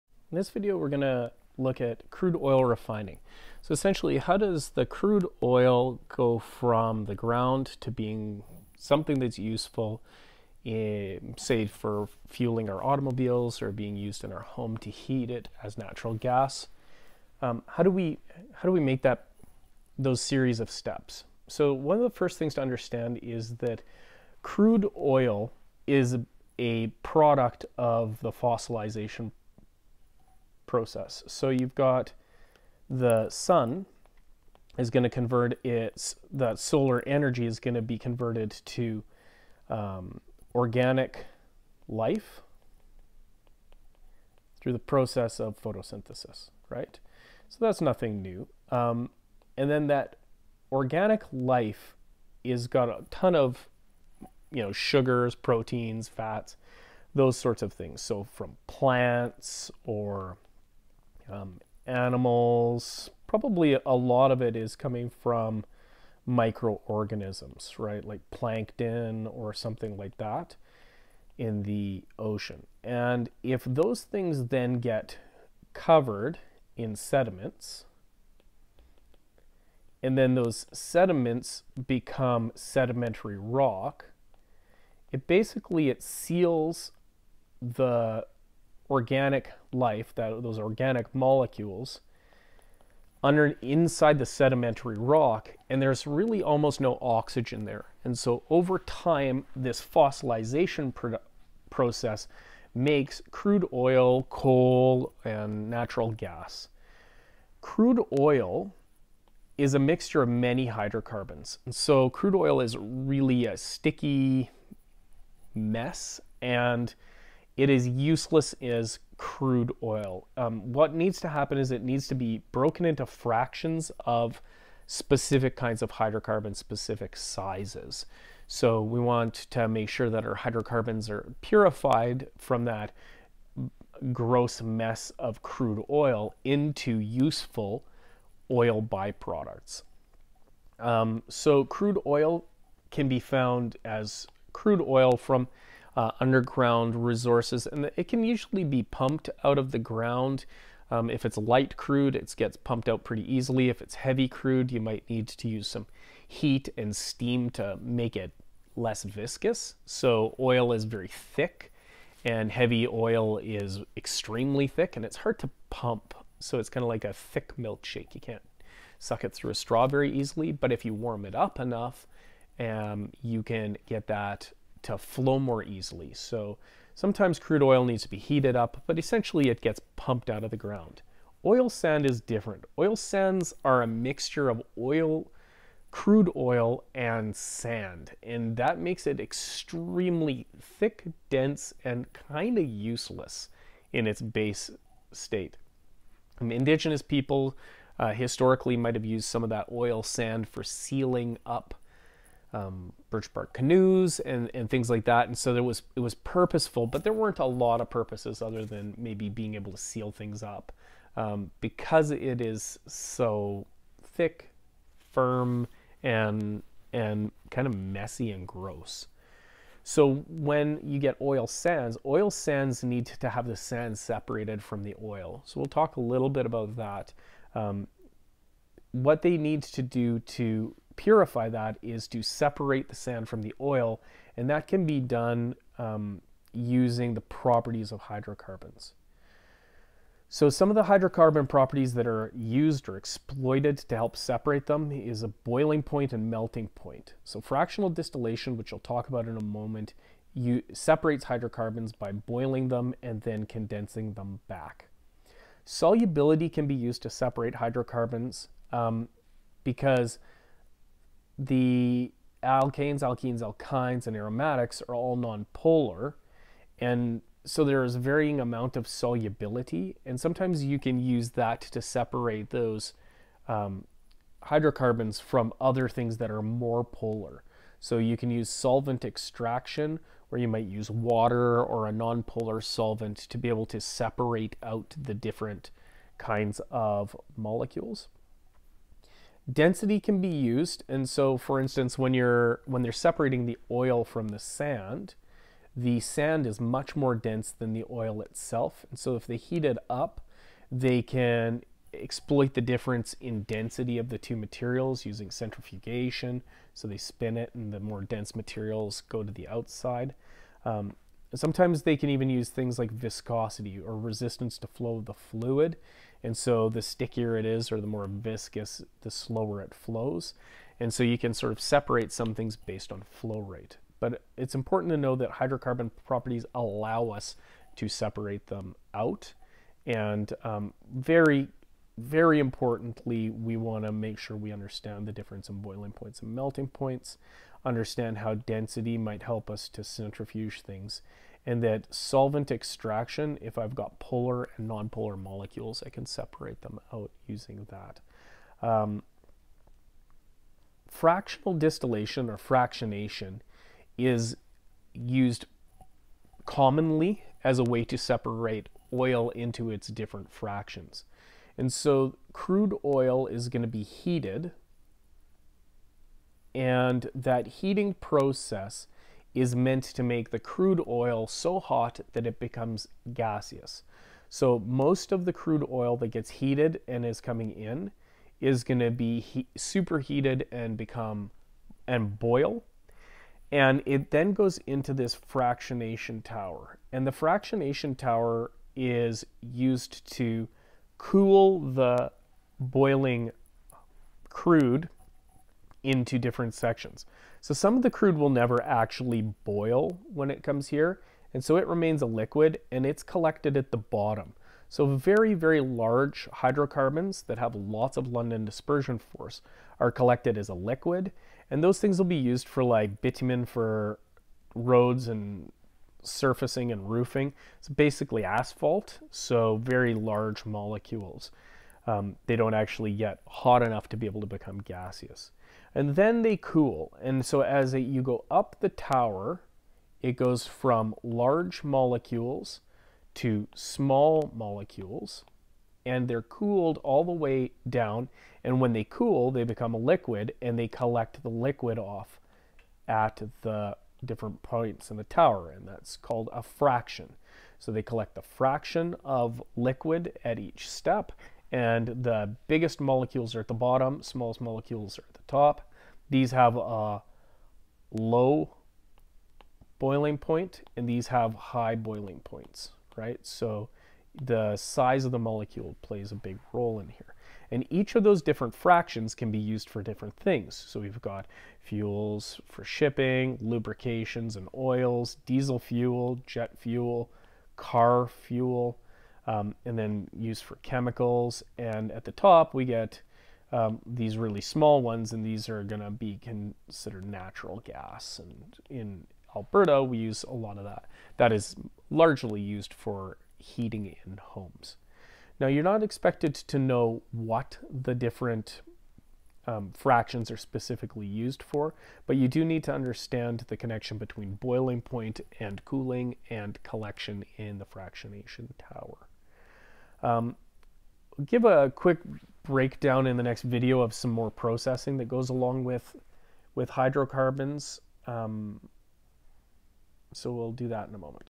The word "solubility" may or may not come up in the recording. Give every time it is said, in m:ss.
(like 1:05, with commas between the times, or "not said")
4:15, 4:28.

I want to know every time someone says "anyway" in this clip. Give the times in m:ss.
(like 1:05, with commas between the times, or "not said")
not said.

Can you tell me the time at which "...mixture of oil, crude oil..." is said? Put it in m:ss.
3:03.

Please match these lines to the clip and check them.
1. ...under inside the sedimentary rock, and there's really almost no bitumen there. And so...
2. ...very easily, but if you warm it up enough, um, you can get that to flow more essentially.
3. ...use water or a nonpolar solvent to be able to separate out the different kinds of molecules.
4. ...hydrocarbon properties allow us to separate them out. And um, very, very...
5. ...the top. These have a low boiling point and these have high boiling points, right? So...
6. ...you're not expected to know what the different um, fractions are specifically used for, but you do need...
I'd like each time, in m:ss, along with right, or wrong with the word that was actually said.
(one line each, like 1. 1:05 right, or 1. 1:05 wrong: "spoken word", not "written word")
1. 1:33 wrong: "oxygen", not "bitumen"
2. 2:49 wrong: "easily", not "essentially"
3. 4:40 right
4. 5:25 right
5. 7:35 right
6. 8:15 right.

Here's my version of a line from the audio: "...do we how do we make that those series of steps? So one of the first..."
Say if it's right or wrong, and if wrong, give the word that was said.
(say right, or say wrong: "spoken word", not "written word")
right.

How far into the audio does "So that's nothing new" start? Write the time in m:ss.
0:47.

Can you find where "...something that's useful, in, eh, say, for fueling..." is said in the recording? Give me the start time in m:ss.
0:08.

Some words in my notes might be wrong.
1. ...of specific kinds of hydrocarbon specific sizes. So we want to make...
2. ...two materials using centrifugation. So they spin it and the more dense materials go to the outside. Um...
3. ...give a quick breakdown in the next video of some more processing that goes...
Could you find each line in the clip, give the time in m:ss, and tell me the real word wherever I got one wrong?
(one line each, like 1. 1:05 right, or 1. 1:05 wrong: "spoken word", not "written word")
1. 2:04 right
2. 5:04 right
3. 8:31 right.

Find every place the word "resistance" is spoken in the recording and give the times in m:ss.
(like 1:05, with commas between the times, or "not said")
5:13.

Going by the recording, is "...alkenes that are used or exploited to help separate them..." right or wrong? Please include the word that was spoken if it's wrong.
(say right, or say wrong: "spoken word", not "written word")
wrong: "properties", not "alkenes".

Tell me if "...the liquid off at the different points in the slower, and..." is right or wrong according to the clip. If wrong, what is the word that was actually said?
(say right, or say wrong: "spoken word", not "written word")
wrong: "tower", not "slower".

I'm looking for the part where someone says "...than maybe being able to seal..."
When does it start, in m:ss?
3:28.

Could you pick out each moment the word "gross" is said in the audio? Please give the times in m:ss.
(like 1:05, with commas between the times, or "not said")
2:14, 3:38.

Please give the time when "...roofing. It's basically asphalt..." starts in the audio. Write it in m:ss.
6:56.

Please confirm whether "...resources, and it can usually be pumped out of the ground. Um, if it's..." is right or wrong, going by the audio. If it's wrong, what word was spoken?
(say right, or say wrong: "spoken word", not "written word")
right.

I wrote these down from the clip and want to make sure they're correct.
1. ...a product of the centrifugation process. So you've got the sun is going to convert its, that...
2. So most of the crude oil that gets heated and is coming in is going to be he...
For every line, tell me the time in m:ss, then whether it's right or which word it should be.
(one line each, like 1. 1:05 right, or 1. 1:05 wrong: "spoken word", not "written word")
1. 0:26 wrong: "fossilization", not "centrifugation"
2. 6:14 right.